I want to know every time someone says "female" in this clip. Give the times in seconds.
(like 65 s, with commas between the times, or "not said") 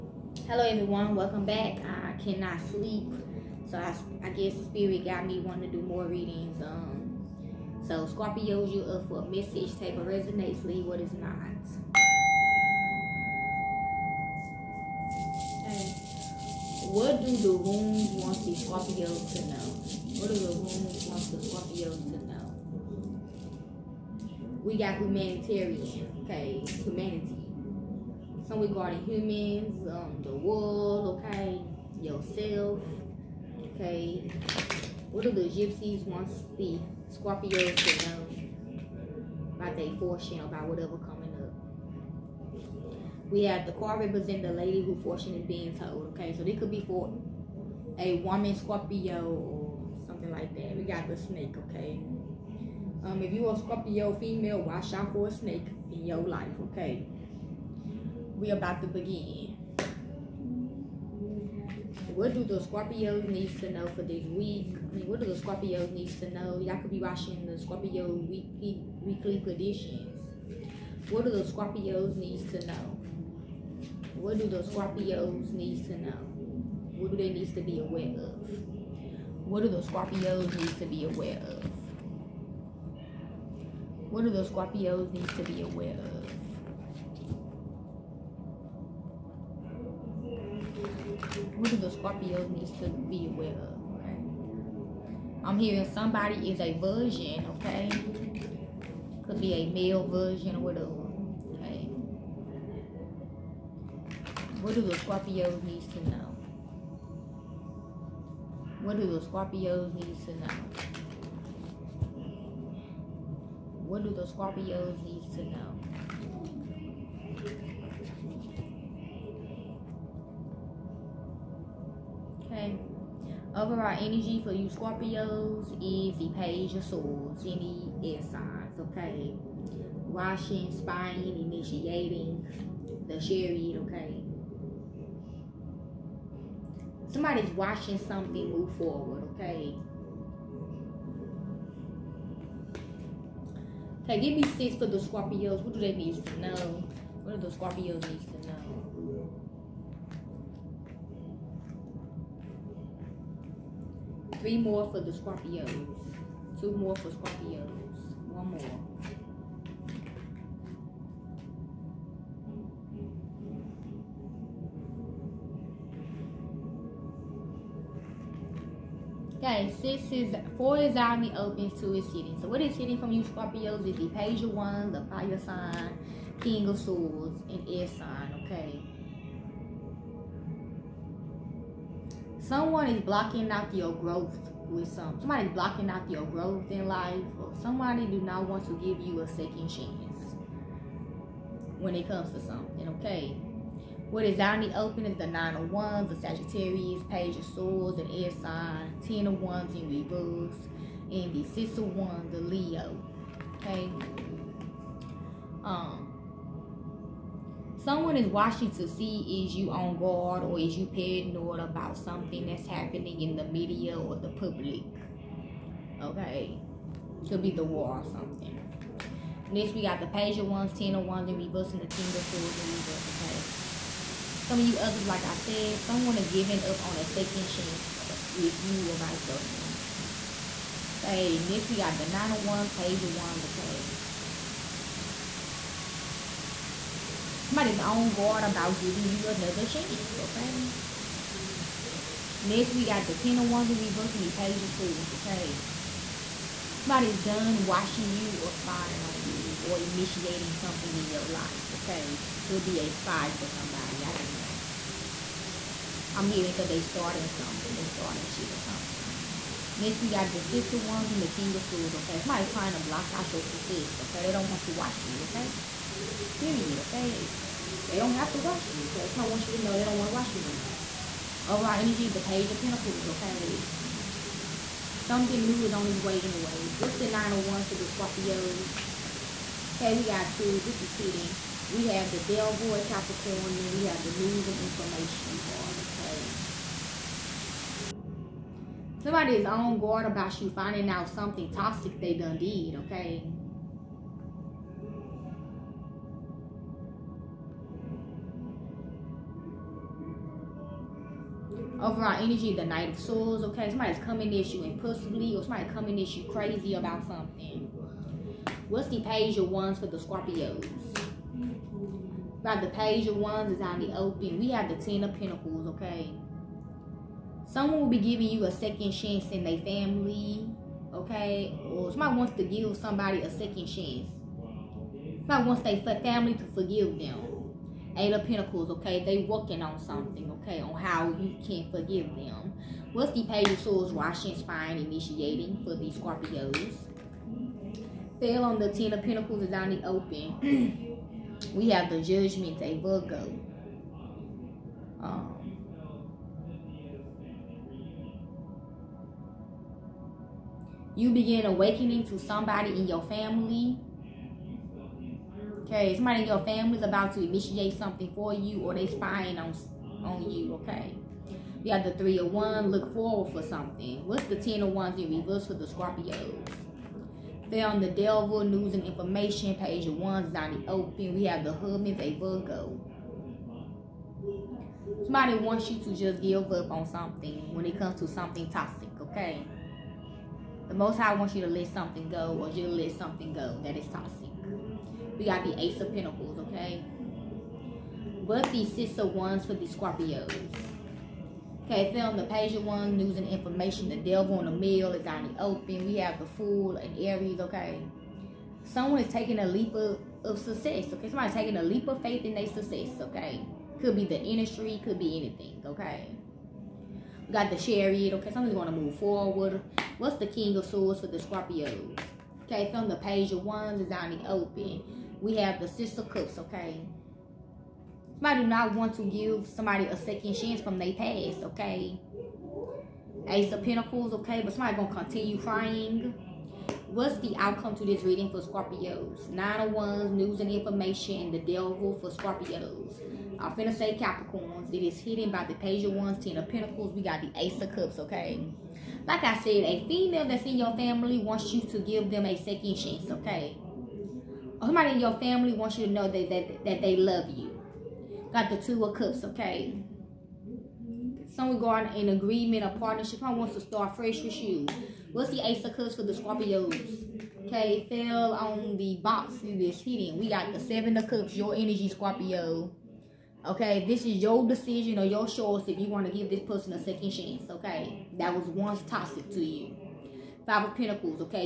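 54 s, 439 s.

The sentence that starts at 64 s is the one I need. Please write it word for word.
I mean, what do the Scorpios need to know?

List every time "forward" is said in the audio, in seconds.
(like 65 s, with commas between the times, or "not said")
138 s, 362 s, 408 s.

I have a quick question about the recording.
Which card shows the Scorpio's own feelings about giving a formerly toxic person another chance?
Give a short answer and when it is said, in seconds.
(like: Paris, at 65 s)
Seven of Cups, at 460 s.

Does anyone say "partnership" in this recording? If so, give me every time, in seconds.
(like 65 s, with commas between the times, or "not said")
452 s.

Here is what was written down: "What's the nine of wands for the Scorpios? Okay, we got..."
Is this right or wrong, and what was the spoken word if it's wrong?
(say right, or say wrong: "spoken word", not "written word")
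right.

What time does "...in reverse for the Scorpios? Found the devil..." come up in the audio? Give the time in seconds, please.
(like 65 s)
365 s.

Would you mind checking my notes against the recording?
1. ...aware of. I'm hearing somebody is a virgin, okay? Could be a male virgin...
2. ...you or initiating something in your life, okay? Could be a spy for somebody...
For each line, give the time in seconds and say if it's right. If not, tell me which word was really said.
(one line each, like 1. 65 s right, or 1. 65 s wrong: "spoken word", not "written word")
1. 93 s right
2. 249 s right.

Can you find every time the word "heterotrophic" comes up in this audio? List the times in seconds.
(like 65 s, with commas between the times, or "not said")
not said.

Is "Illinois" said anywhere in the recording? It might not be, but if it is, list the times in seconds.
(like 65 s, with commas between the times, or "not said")
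not said.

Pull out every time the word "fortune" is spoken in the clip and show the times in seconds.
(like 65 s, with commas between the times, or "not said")
39 s, 44 s.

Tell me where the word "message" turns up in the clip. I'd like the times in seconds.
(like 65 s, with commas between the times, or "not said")
9 s.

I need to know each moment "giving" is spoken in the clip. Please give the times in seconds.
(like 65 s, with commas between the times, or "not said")
226 s, 238 s, 317 s.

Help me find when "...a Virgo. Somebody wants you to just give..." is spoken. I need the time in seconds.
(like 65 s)
372 s.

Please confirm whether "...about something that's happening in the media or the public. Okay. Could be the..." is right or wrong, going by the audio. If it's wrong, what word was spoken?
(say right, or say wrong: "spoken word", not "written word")
right.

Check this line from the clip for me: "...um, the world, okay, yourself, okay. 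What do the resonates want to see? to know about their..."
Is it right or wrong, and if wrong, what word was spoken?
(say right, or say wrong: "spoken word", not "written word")
wrong: "gypsies", not "resonates".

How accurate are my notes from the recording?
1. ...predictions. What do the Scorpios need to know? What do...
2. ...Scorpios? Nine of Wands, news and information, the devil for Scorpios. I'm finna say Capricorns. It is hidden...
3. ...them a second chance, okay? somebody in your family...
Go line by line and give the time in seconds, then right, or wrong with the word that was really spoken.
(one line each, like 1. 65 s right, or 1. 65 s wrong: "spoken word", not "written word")
1. 69 s right
2. 428 s right
3. 442 s right.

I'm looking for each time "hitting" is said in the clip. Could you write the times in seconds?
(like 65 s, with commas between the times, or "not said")
280 s, 459 s.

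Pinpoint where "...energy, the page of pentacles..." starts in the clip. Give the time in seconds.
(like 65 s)
271 s.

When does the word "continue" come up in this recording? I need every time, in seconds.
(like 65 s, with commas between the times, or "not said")
424 s.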